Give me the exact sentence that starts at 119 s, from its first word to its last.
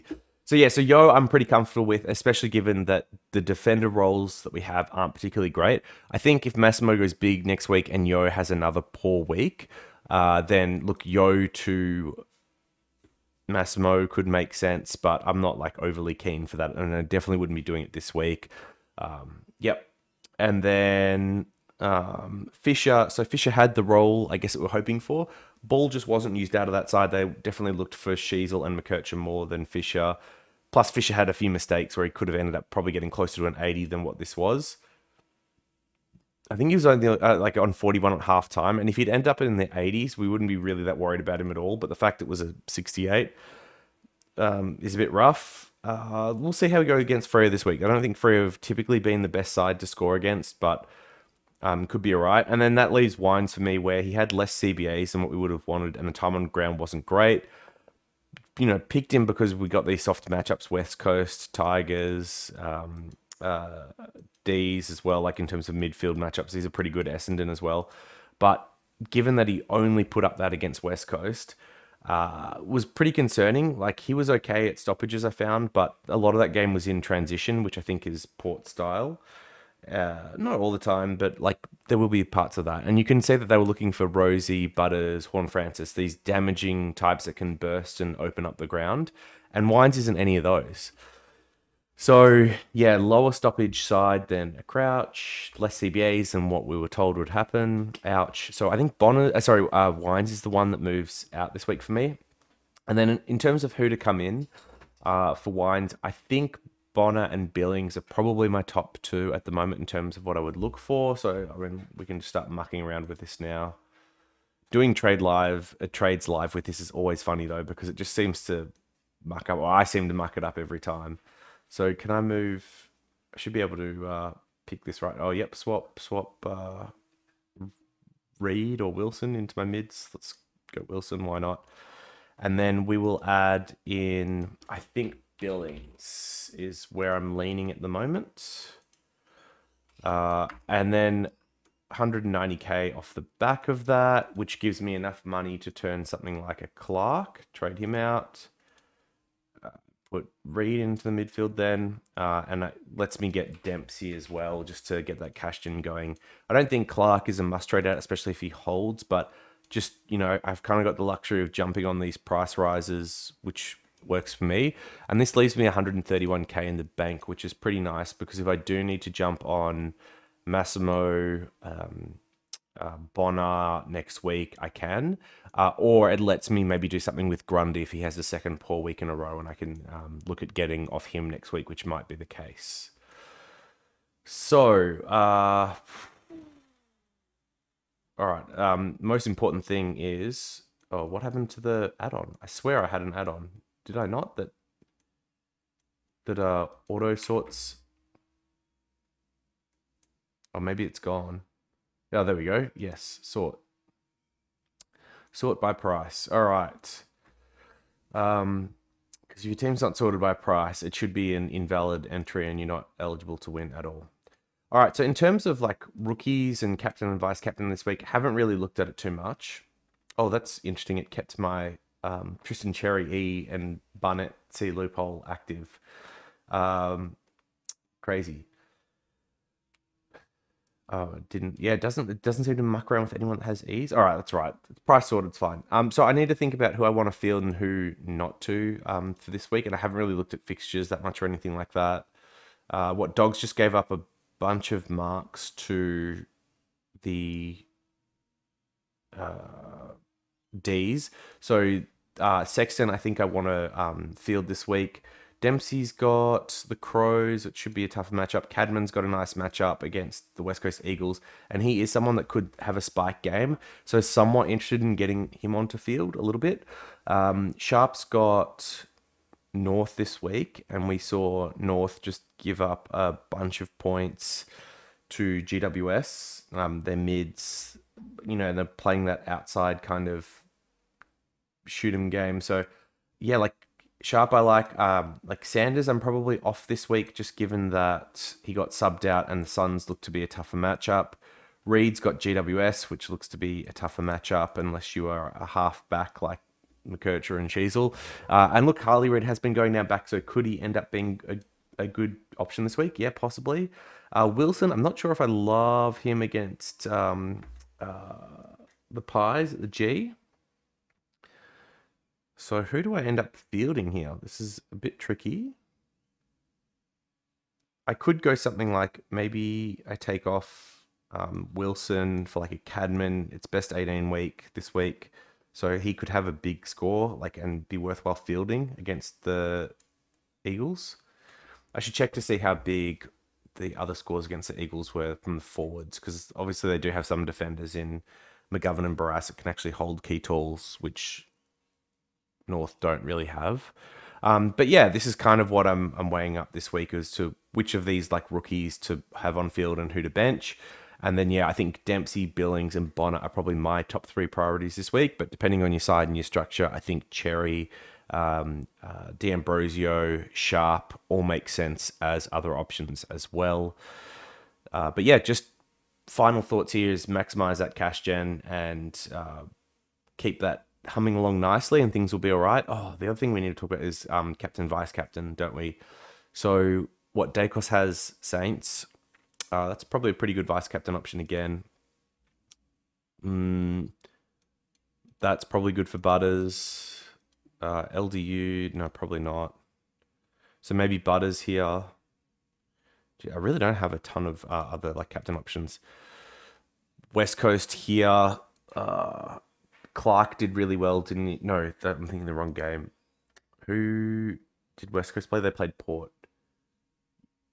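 Or I seem to muck it up every time.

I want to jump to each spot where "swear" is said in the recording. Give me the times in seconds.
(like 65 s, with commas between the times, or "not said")
192 s.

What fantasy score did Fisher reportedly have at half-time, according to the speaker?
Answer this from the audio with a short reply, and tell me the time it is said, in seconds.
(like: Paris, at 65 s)
41, at 37 s.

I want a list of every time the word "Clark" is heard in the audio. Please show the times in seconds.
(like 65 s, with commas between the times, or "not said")
146 s, 156 s, 399 s.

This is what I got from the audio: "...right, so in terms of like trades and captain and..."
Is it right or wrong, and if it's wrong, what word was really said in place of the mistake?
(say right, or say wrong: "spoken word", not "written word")
wrong: "rookies", not "trades".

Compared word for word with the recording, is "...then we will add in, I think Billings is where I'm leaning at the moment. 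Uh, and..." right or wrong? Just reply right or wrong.
right.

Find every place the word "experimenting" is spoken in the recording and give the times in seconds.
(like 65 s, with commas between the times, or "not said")
not said.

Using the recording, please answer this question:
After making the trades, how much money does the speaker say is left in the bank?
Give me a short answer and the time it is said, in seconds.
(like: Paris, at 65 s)
131K, at 165 s.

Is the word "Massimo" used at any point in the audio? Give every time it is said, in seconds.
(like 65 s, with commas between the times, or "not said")
6 s, 13 s, 170 s.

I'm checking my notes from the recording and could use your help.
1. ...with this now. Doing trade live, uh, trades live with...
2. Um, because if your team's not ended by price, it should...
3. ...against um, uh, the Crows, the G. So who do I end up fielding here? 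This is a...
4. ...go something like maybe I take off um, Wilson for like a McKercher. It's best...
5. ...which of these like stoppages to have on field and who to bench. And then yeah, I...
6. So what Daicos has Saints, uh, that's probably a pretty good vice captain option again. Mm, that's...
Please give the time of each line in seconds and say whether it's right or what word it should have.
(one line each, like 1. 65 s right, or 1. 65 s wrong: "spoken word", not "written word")
1. 113 s right
2. 208 s wrong: "sorted", not "ended"
3. 306 s wrong: "Pies", not "Crows"
4. 318 s wrong: "Cadman", not "McKercher"
5. 347 s wrong: "rookies", not "stoppages"
6. 376 s right.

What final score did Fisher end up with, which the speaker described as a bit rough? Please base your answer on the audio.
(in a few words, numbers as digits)
68.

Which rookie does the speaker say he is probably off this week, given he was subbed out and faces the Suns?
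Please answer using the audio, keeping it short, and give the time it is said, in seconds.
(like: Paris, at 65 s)
Sanders, at 285 s.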